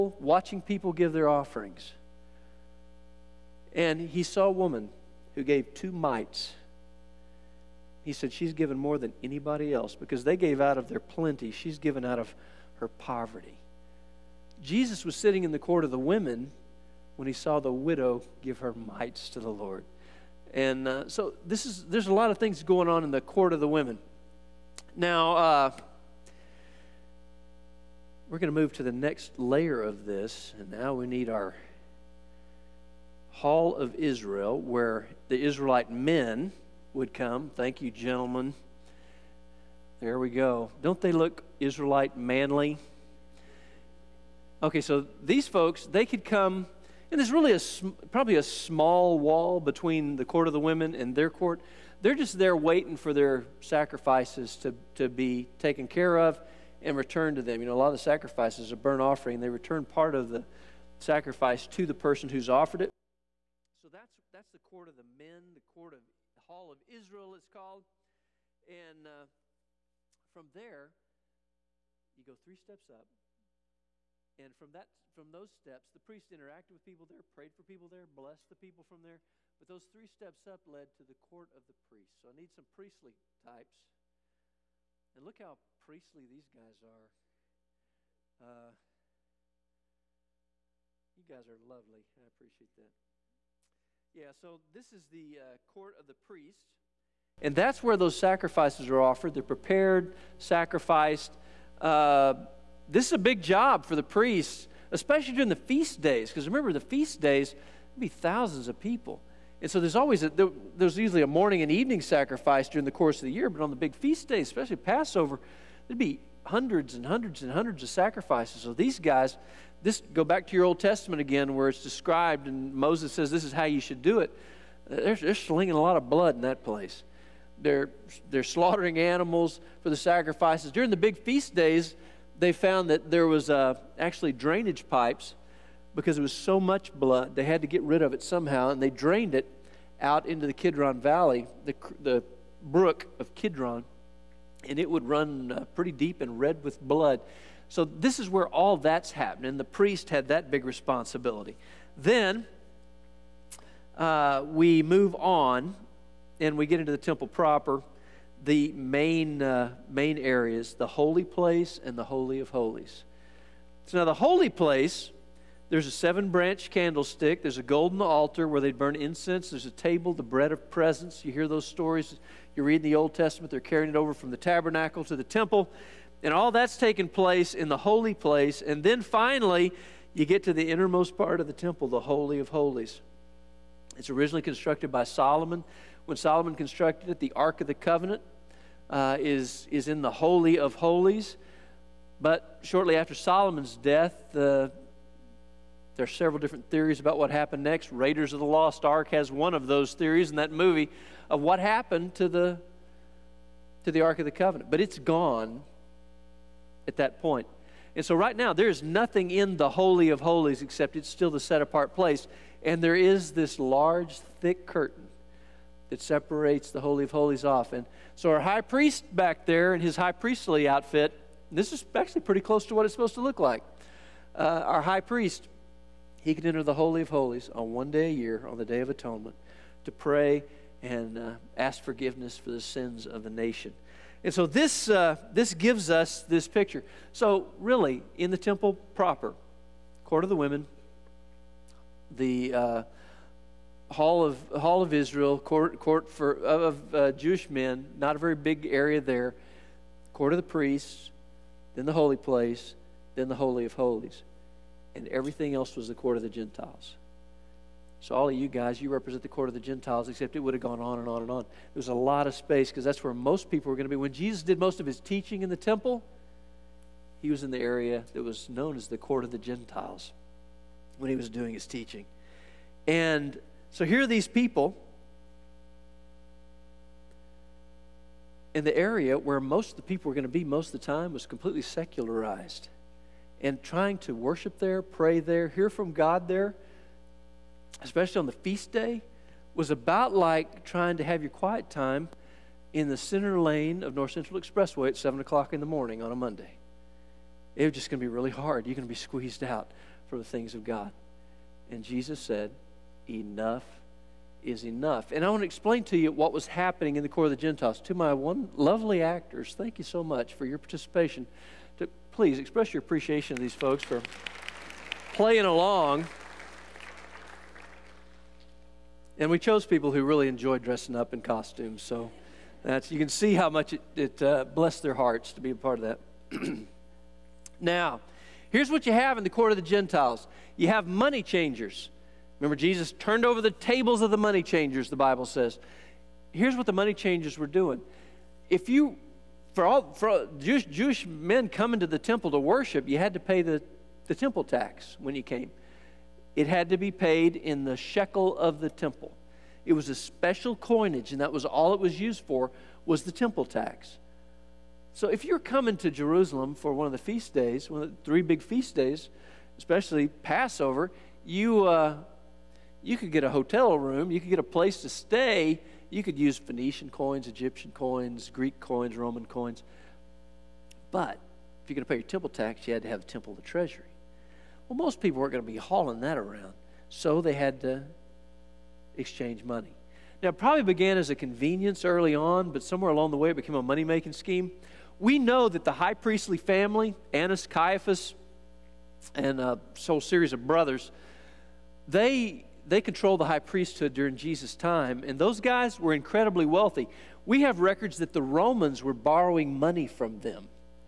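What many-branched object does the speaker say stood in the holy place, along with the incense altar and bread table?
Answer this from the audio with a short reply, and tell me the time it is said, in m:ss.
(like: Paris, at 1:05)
seven branch candlestick, at 2:45.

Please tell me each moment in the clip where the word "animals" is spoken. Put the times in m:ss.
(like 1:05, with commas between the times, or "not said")
2:08.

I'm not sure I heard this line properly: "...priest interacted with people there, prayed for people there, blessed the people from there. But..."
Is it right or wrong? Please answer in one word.
right.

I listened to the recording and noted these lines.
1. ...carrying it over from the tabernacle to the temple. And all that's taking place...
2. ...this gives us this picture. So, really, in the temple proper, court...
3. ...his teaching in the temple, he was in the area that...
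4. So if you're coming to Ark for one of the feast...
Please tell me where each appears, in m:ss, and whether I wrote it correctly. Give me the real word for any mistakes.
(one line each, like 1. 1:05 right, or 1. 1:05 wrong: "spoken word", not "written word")
1. 2:53 right
2. 3:55 right
3. 4:24 right
4. 5:54 wrong: "Jerusalem", not "Ark".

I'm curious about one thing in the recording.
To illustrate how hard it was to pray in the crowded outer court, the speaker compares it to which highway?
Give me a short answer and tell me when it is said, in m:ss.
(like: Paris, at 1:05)
North Central Expressway, at 4:53.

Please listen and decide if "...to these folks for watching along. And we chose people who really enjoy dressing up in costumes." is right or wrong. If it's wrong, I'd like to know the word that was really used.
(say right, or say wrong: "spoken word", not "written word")
wrong: "playing", not "watching".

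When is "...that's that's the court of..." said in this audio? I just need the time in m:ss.
1:03.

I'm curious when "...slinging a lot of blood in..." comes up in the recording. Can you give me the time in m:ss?
2:05.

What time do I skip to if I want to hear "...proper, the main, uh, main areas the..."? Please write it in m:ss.
2:37.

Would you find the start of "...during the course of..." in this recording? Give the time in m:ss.
1:52.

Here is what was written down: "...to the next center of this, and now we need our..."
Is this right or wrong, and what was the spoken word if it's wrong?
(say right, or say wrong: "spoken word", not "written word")
wrong: "layer", not "center".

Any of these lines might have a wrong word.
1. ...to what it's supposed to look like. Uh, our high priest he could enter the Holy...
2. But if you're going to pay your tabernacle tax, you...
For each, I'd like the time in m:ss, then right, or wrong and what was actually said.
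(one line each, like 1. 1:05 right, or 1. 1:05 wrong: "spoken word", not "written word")
1. 3:42 right
2. 6:10 wrong: "temple", not "tabernacle".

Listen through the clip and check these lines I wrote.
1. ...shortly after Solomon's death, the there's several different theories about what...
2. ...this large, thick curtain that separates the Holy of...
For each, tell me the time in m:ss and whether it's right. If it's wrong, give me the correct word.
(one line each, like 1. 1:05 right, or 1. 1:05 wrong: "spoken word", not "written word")
1. 3:12 right
2. 3:33 right.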